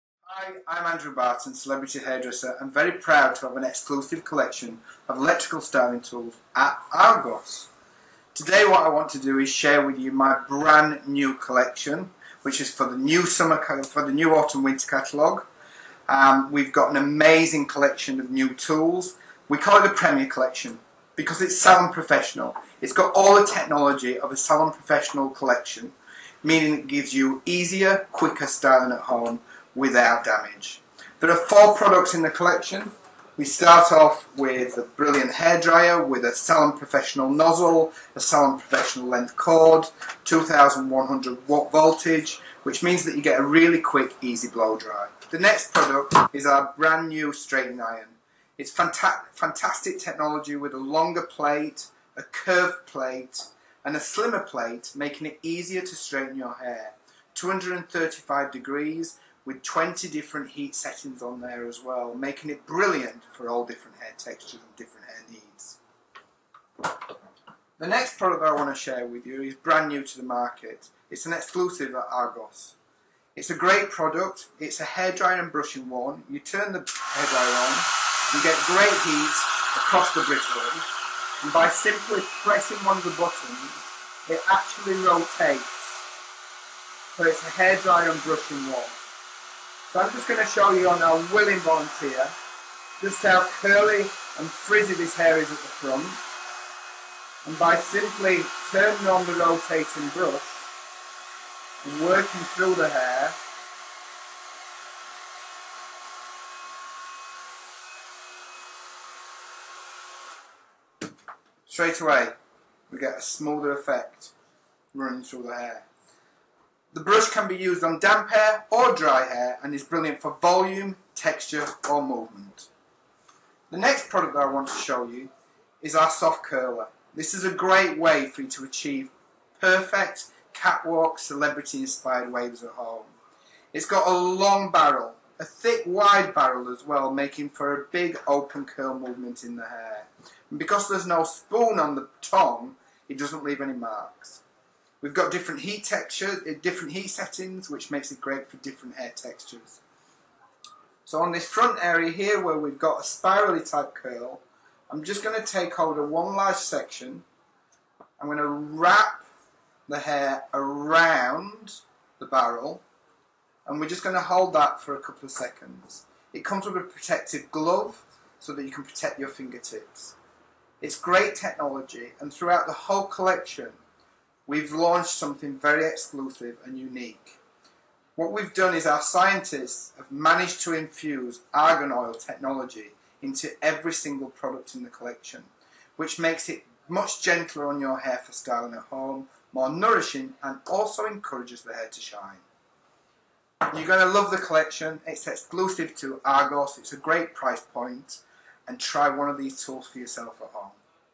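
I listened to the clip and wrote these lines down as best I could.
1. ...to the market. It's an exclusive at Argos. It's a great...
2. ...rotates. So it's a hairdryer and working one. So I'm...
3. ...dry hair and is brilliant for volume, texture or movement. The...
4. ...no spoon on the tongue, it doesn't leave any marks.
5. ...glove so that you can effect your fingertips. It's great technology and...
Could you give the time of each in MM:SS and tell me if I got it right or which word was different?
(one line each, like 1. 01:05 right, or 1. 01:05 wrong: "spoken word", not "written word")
1. 01:10 right
2. 01:25 wrong: "brushing", not "working"
3. 01:58 right
4. 02:21 right
5. 02:47 wrong: "protect", not "effect".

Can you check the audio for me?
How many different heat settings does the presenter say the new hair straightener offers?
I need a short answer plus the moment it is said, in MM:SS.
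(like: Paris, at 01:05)
20, at 00:59.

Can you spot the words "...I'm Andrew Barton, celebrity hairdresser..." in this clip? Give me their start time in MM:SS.
00:00.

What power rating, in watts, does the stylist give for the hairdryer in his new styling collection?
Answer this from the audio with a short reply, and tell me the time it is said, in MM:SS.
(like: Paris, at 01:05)
2100 watts, at 00:40.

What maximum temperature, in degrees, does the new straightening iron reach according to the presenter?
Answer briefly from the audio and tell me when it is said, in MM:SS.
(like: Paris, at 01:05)
235 degrees, at 00:57.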